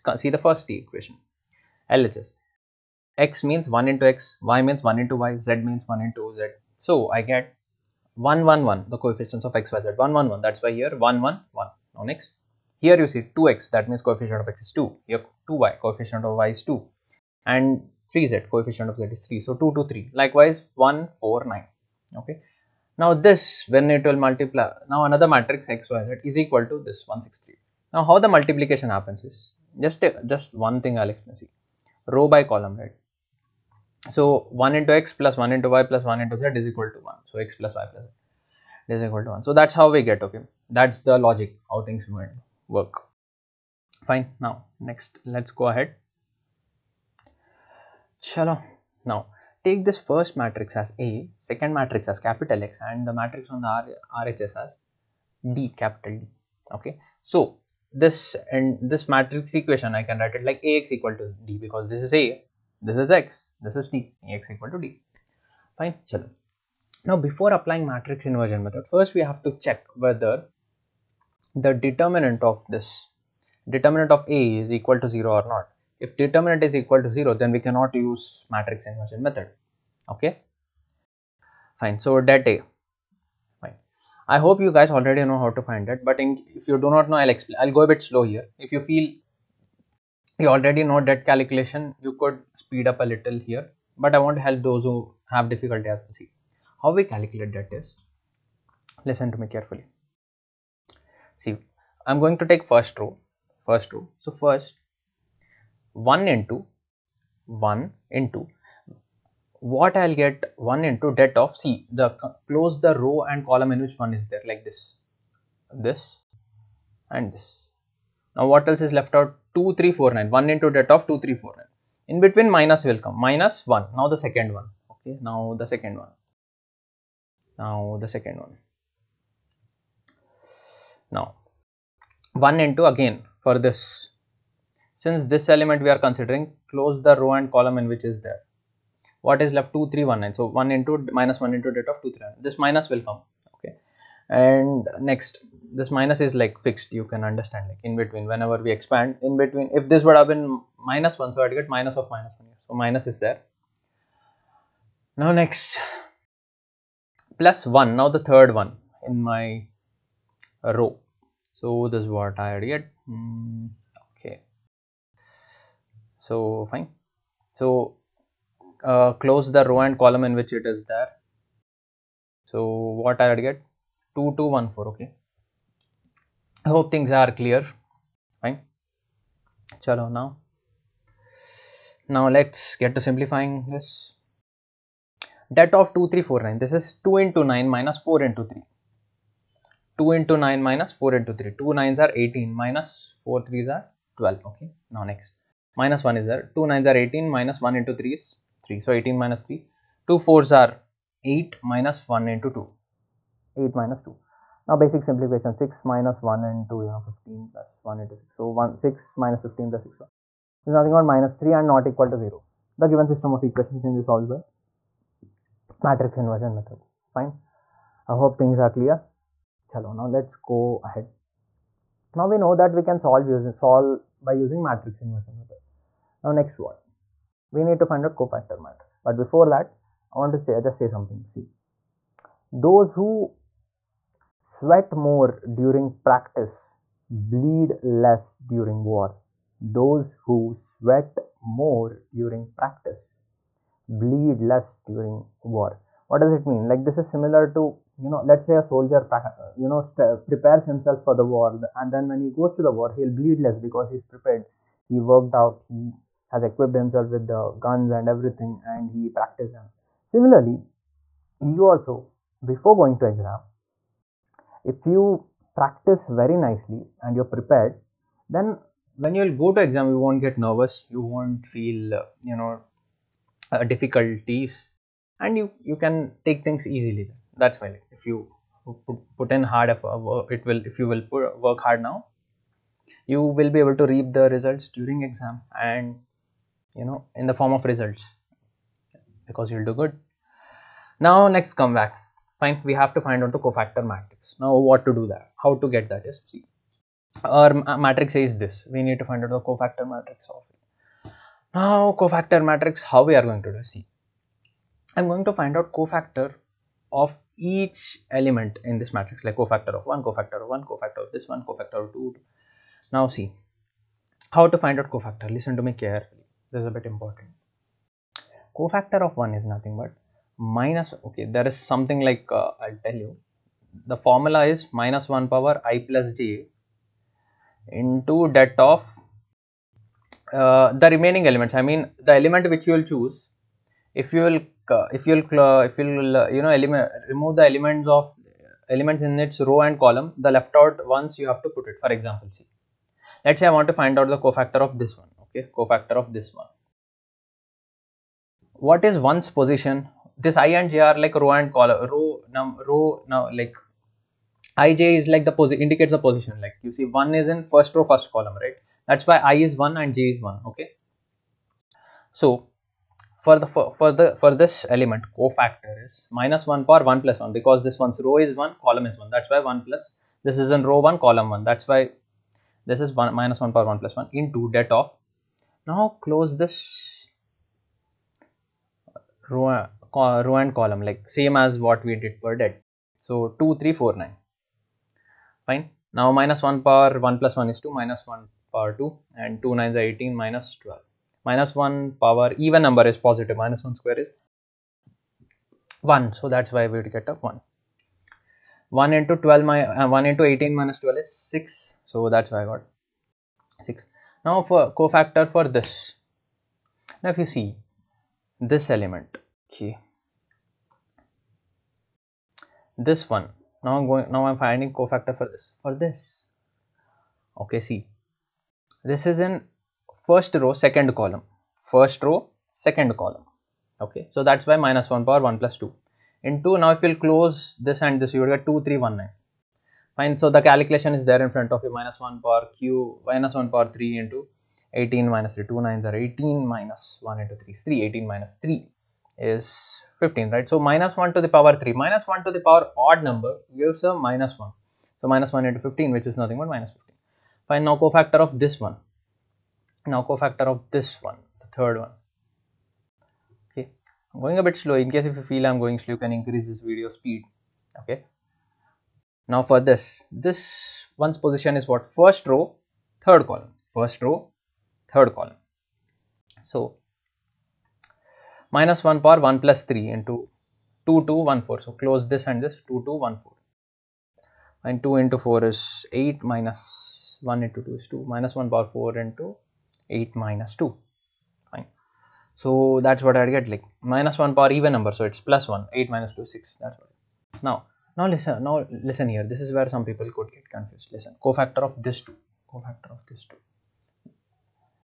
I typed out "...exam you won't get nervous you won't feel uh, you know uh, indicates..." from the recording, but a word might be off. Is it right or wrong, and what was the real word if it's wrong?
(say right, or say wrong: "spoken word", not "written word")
wrong: "difficulties", not "indicates".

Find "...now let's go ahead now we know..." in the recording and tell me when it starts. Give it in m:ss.
3:40.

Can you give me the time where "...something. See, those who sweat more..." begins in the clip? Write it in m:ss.
3:50.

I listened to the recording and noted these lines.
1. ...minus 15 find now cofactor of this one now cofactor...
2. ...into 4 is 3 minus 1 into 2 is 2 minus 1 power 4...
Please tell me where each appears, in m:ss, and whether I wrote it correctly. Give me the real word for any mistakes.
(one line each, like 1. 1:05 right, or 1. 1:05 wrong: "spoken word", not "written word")
1. 7:26 right
2. 7:55 wrong: "8", not "3".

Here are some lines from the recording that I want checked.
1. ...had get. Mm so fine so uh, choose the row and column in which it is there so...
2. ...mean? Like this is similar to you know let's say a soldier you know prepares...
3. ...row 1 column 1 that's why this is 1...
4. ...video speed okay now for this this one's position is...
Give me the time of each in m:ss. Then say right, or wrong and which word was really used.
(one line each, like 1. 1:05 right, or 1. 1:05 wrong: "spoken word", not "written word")
1. 2:42 wrong: "close", not "choose"
2. 4:06 right
3. 6:10 right
4. 7:36 right.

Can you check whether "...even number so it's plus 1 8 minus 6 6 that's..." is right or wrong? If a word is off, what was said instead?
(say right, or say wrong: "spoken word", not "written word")
wrong: "2", not "6".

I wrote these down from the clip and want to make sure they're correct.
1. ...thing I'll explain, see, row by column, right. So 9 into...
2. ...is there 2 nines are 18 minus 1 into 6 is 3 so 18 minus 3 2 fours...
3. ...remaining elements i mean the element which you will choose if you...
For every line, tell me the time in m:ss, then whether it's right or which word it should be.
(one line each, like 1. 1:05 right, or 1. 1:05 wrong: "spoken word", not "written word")
1. 0:30 wrong: "1", not "9"
2. 3:16 wrong: "3", not "6"
3. 5:30 right.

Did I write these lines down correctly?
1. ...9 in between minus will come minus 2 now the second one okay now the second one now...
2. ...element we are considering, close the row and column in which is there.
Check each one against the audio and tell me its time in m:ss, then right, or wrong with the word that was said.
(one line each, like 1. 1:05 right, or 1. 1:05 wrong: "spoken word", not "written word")
1. 2:01 wrong: "1", not "2"
2. 2:15 right.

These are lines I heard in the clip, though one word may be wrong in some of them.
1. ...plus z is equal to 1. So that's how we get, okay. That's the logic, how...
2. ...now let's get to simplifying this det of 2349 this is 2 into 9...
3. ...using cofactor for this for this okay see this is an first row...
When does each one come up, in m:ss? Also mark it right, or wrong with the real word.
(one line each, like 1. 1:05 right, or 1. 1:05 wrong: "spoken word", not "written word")
1. 0:37 right
2. 3:02 right
3. 6:54 wrong: "finding", not "using".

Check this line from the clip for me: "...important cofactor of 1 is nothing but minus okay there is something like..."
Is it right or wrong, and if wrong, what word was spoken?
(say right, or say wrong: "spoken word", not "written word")
right.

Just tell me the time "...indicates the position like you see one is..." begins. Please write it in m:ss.
5:55.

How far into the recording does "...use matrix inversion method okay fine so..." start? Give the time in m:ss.
1:18.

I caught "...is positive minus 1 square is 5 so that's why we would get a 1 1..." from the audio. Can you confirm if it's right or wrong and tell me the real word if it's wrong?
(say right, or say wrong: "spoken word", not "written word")
wrong: "1", not "5".